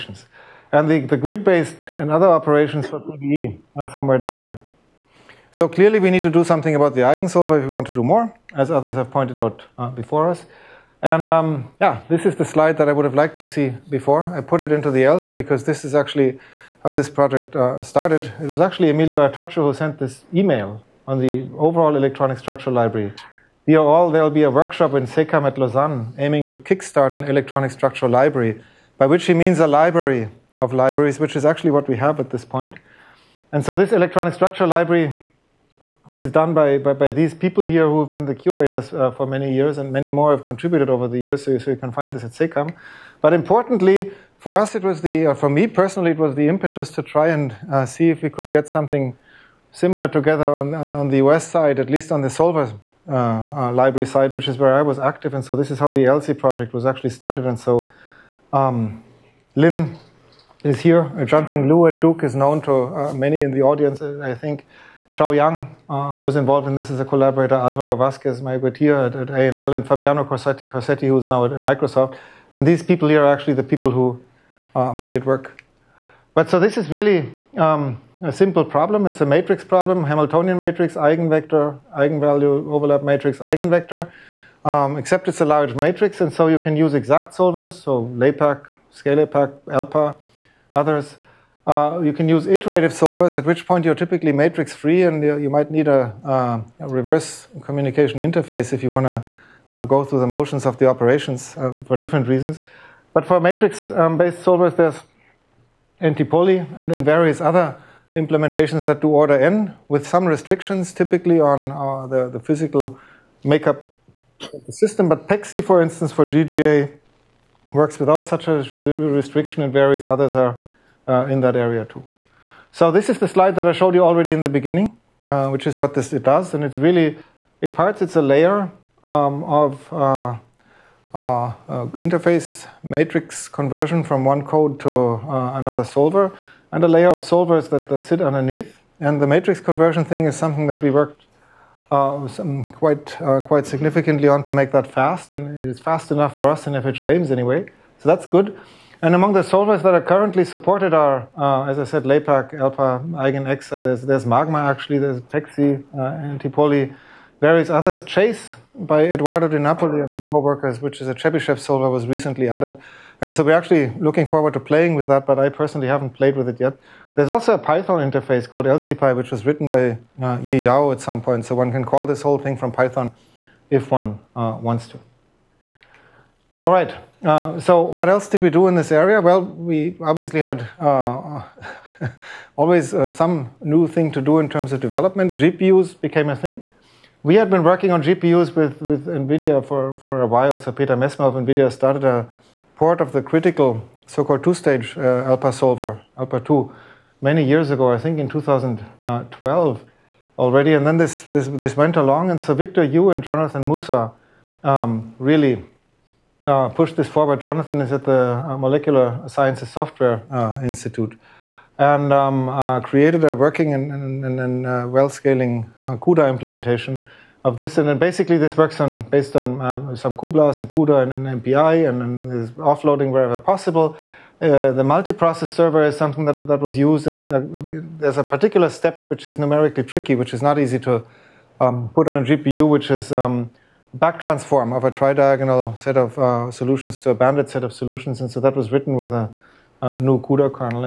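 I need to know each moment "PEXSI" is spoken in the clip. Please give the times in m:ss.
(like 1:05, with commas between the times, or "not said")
1:55, 2:35.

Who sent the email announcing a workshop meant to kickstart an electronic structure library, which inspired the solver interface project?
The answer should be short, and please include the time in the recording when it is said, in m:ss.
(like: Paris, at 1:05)
Emilio Artacho, at 0:18.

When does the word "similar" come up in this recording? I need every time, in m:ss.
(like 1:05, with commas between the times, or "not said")
0:49.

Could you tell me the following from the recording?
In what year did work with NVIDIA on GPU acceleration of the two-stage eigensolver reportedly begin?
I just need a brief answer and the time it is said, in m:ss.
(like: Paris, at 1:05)
2012, at 3:18.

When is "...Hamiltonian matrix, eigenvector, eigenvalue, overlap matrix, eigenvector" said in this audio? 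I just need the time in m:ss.
1:20.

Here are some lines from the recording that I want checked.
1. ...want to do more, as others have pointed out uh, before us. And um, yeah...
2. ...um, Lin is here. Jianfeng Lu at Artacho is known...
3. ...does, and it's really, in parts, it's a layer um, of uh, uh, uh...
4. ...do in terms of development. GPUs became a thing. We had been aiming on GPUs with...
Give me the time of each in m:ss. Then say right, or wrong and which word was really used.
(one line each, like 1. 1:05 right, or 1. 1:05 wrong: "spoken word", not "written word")
1. 0:07 right
2. 0:58 wrong: "Duke", not "Artacho"
3. 2:06 right
4. 3:04 wrong: "working", not "aiming".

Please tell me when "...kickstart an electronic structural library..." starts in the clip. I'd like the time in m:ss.
0:26.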